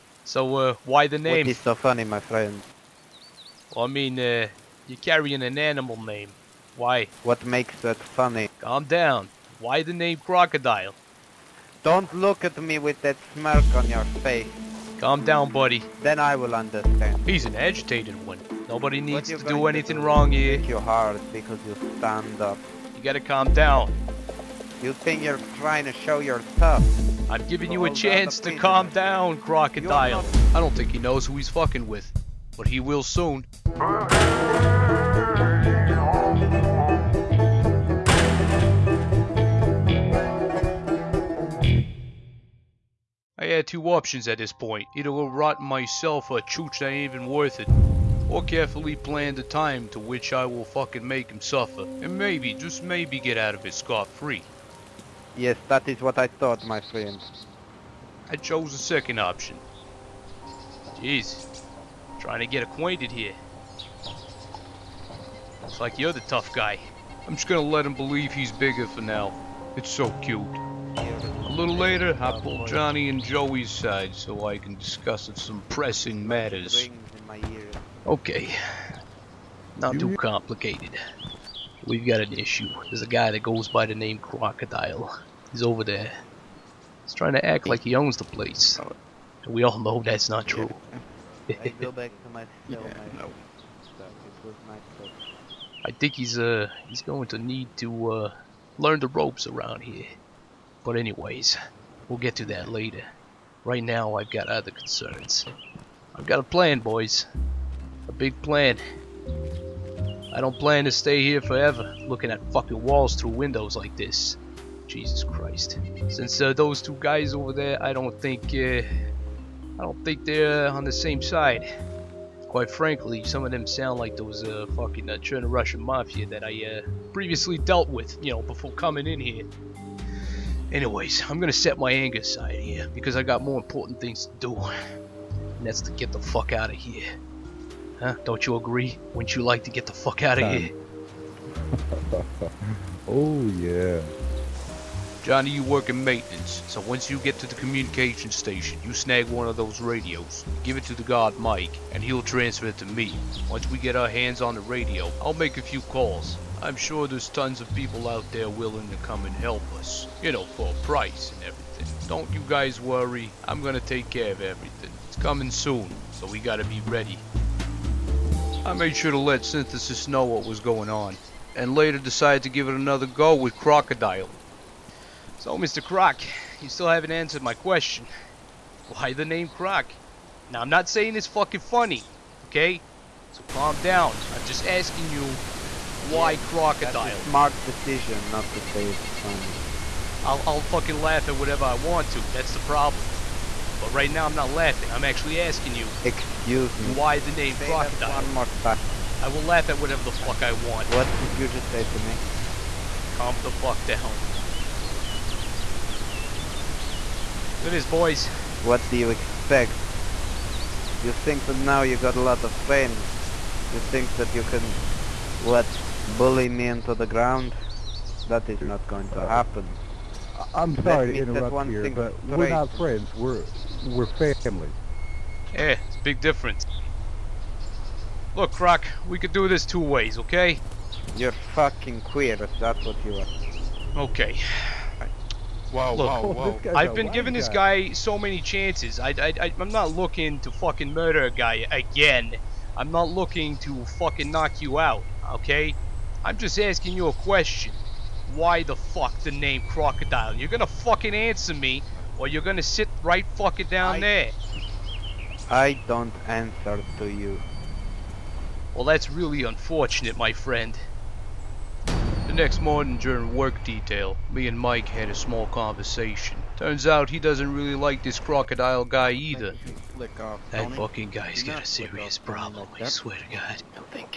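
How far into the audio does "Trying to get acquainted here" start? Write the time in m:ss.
1:02.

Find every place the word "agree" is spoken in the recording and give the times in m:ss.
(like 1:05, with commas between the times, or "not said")
2:18.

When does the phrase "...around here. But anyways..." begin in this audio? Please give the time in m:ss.
1:39.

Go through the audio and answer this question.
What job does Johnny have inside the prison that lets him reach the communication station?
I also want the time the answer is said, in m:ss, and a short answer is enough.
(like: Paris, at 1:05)
maintenance, at 2:26.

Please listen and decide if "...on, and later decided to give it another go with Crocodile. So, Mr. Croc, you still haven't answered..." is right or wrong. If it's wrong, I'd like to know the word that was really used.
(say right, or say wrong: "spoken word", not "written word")
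right.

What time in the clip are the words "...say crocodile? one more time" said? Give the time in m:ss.
3:17.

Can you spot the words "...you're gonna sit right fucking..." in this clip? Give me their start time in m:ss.
4:12.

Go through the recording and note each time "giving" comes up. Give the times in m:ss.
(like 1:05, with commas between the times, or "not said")
0:27, 3:57.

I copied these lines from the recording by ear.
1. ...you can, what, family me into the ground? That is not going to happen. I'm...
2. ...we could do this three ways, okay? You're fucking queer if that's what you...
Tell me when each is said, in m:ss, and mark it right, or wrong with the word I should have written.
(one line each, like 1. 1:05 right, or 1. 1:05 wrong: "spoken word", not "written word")
1. 3:34 wrong: "bully", not "family"
2. 3:49 wrong: "two", not "three".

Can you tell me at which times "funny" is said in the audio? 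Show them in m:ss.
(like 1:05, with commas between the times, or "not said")
0:01, 0:07, 3:01, 3:09.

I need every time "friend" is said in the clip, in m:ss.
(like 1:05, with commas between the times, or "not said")
0:02, 0:56, 3:32, 3:42, 4:20.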